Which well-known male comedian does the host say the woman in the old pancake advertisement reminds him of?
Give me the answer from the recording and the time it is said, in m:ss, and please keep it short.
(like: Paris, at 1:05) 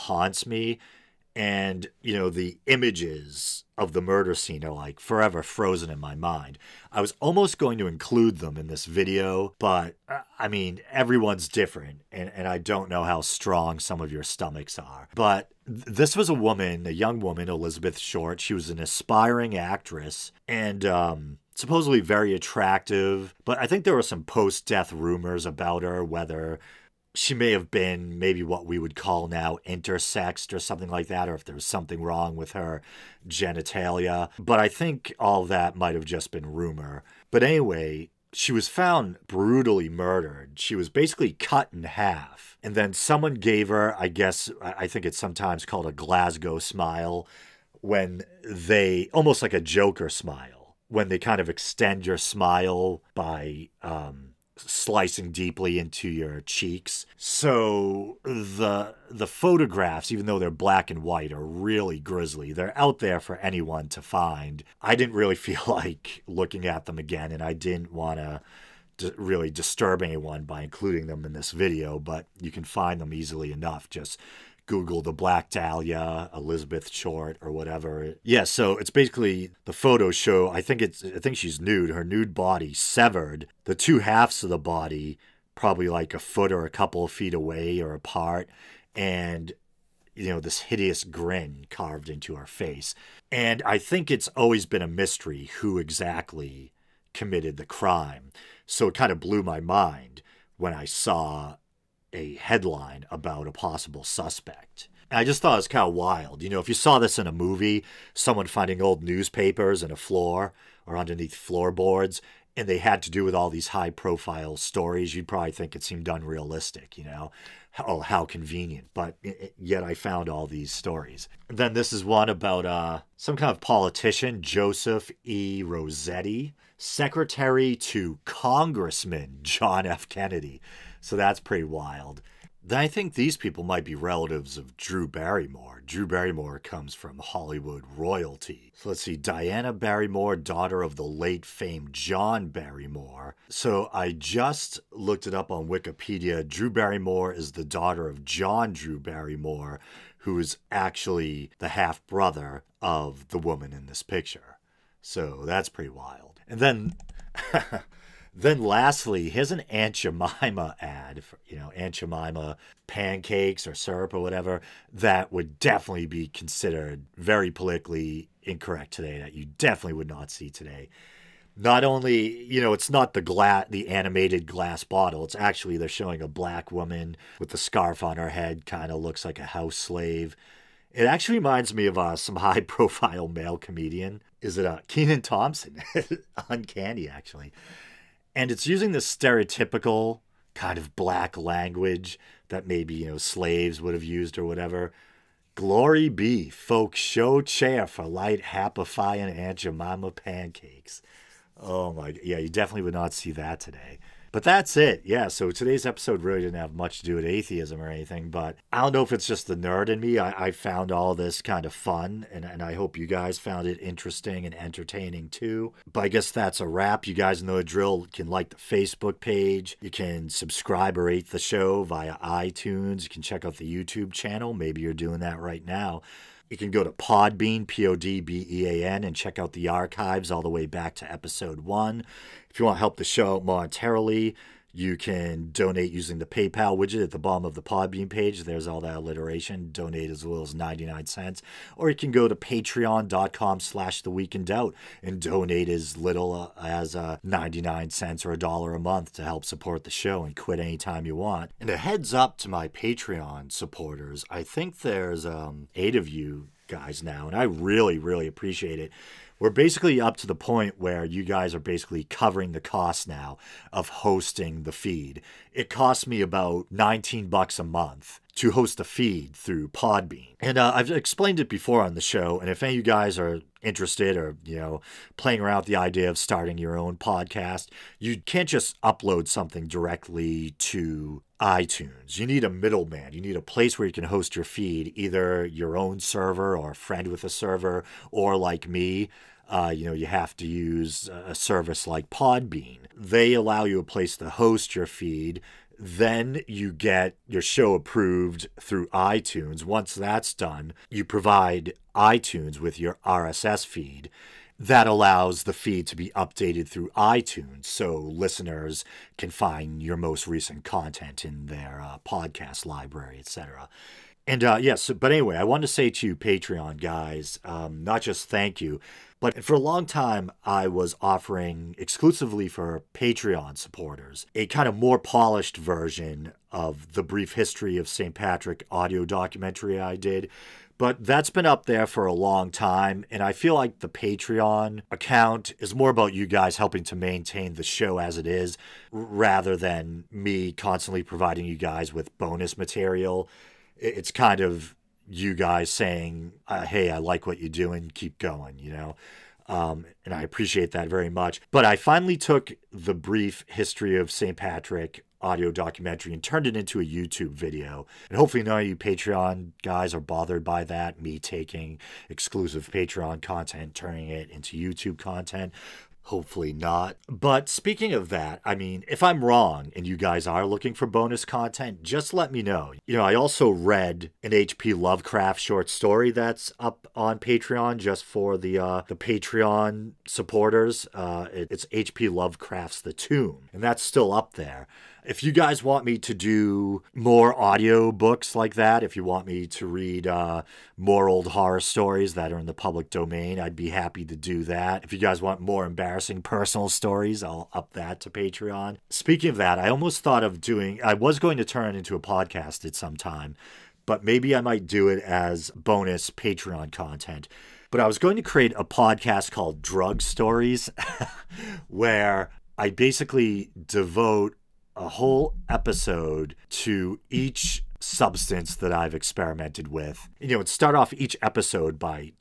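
Kenan Thompson, at 3:04.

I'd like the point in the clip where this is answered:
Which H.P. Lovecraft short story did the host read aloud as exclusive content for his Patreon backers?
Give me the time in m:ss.
6:22.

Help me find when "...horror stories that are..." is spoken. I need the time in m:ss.
6:31.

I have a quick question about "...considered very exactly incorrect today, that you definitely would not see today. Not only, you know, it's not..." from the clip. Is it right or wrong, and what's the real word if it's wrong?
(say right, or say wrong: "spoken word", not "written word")
wrong: "politically", not "exactly".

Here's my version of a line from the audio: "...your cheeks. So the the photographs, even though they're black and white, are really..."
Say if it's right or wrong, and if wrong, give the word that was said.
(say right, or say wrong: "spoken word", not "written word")
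right.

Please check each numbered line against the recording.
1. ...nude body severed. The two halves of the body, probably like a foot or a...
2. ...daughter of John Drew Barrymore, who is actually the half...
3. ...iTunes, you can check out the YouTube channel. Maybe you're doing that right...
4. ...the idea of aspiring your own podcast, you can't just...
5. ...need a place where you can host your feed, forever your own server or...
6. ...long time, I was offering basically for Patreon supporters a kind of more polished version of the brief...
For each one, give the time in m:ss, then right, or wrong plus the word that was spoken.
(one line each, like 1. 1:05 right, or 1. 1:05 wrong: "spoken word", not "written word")
1. 1:22 right
2. 2:27 right
3. 3:42 right
4. 4:35 wrong: "starting", not "aspiring"
5. 4:43 wrong: "either", not "forever"
6. 5:19 wrong: "exclusively", not "basically".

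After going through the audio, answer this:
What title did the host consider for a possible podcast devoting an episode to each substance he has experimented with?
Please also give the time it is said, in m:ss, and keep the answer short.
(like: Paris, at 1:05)
Drug Stories, at 6:49.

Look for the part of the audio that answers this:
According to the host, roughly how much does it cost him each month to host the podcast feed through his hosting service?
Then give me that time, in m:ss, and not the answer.
4:26.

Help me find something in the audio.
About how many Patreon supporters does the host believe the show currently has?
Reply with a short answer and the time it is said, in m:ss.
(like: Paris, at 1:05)
8, at 4:15.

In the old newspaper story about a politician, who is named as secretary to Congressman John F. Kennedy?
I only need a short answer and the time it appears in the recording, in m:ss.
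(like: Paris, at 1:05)
Joseph E. Rossetti, at 2:04.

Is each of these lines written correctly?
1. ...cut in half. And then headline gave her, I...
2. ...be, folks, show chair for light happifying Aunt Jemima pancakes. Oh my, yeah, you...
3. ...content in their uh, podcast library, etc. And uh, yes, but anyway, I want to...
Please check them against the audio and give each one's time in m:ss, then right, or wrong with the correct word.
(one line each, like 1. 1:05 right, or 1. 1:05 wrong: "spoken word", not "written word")
1. 0:41 wrong: "someone", not "headline"
2. 3:16 right
3. 5:10 right.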